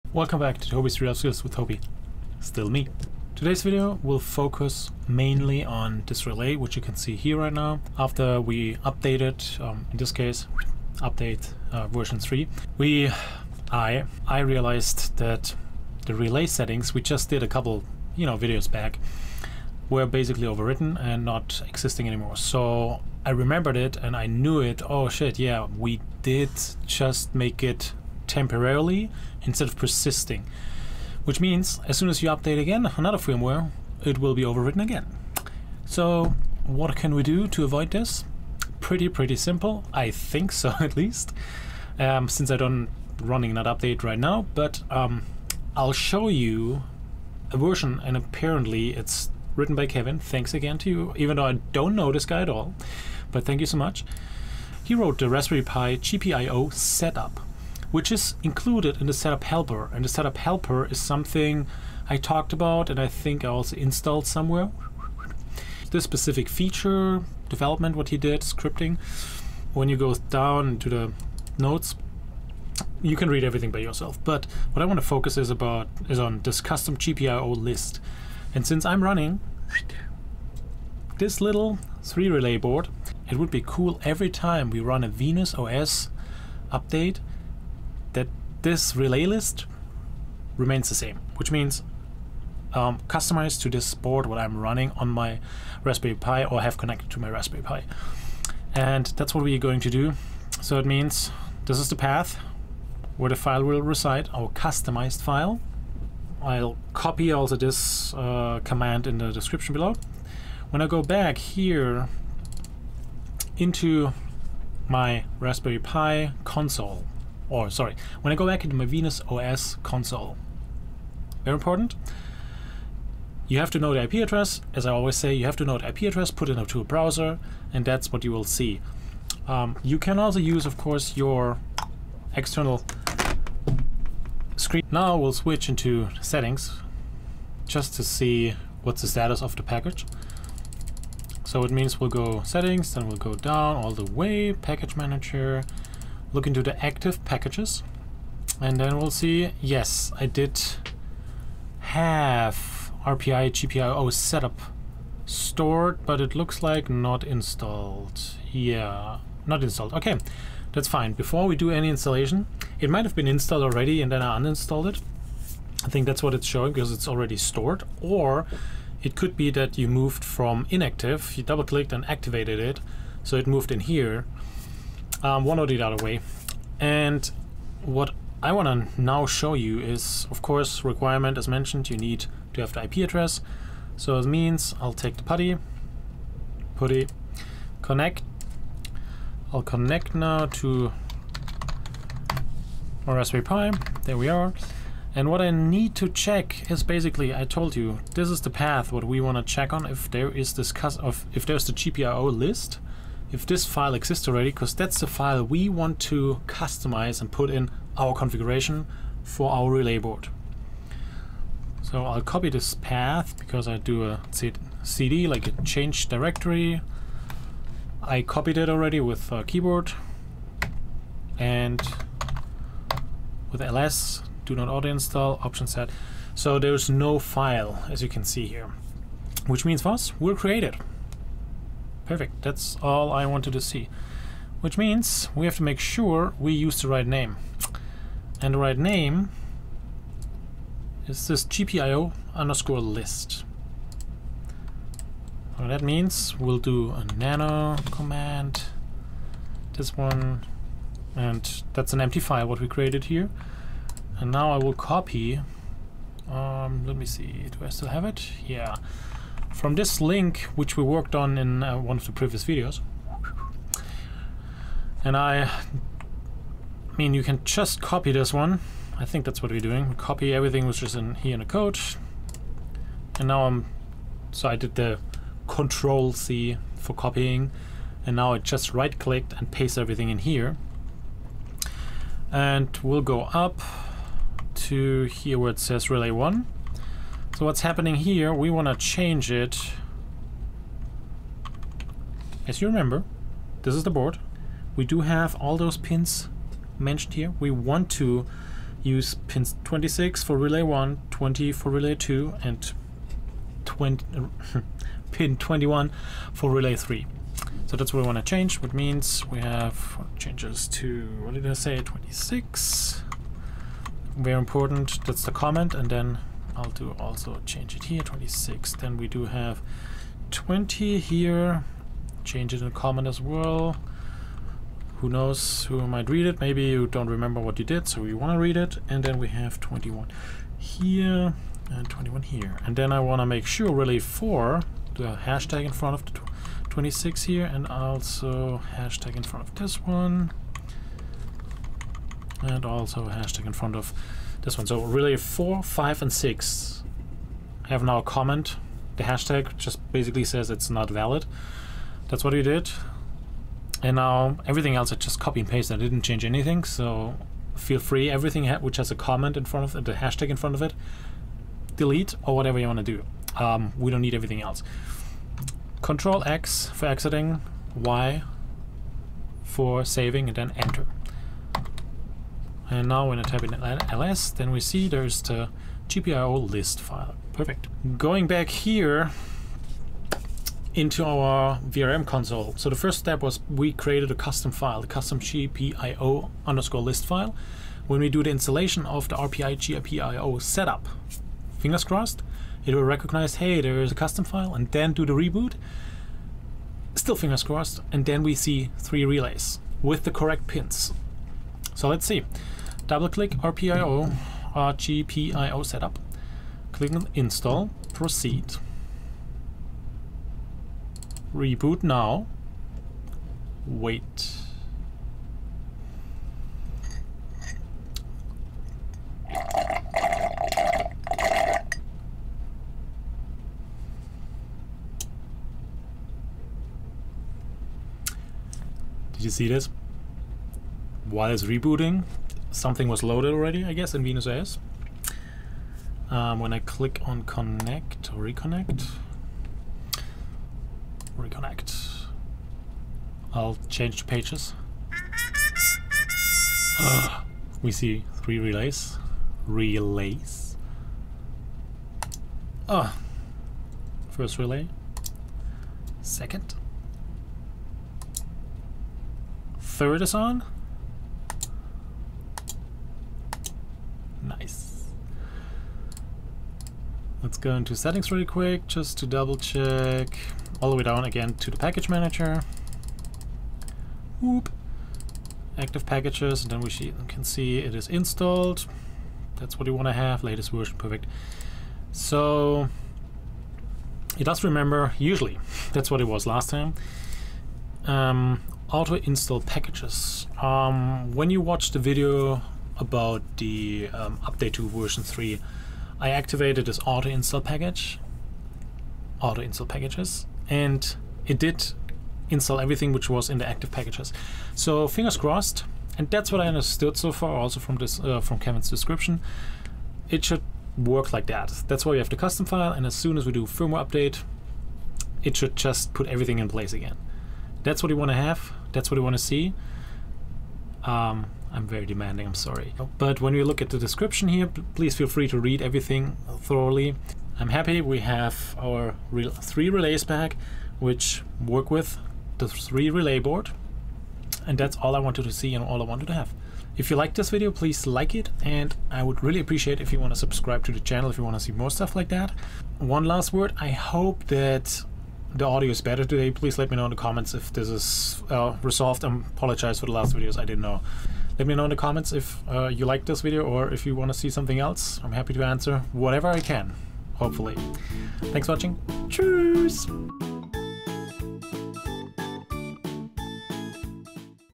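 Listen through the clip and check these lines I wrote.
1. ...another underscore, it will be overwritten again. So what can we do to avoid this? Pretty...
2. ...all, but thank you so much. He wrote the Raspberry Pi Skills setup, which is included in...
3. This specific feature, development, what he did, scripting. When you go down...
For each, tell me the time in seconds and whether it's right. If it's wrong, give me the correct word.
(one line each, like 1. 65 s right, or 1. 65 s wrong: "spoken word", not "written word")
1. 32 s wrong: "firmware", not "underscore"
2. 52 s wrong: "GPIO", not "Skills"
3. 65 s right.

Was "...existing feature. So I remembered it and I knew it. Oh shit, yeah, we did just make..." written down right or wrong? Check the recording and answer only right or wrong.
wrong.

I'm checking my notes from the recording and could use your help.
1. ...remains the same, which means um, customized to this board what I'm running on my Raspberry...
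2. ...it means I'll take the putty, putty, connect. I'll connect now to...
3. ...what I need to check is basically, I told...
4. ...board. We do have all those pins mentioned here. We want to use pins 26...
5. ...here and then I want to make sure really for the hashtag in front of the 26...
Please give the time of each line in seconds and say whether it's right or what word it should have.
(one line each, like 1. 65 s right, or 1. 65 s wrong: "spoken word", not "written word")
1. 90 s right
2. 184 s right
3. 195 s right
4. 293 s right
5. 332 s right.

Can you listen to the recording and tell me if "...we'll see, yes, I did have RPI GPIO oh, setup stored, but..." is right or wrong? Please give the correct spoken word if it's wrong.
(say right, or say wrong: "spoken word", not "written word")
right.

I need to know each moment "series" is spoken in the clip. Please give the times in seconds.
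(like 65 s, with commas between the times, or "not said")
not said.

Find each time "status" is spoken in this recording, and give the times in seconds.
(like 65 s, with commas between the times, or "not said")
139 s.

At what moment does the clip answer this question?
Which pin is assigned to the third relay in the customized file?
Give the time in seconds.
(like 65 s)
305 s.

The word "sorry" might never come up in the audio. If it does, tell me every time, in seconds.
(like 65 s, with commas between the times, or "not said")
117 s, 522 s.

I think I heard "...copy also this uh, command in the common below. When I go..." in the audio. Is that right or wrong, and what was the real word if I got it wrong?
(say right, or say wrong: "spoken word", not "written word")
wrong: "description", not "common".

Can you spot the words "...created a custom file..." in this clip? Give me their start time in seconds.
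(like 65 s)
383 s.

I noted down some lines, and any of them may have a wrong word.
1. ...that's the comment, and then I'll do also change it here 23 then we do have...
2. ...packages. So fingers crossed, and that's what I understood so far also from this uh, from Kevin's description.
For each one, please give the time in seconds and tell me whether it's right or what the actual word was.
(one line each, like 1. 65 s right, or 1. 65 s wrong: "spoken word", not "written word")
1. 315 s wrong: "26", not "23"
2. 503 s right.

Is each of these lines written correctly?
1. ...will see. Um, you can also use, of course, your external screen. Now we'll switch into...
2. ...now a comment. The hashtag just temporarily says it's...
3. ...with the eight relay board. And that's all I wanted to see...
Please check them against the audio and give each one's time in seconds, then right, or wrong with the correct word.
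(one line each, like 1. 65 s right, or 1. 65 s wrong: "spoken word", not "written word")
1. 128 s right
2. 347 s wrong: "basically", not "temporarily"
3. 531 s wrong: "three", not "eight".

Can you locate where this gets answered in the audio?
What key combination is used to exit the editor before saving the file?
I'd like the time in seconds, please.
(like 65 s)
365 s.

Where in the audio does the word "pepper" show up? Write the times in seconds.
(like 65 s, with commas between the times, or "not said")
not said.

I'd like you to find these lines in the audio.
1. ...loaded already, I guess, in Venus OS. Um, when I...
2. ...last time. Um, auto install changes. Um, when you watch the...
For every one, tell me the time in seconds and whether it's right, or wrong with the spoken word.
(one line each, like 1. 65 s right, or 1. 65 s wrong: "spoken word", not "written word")
1. 433 s right
2. 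486 s wrong: "packages", not "changes".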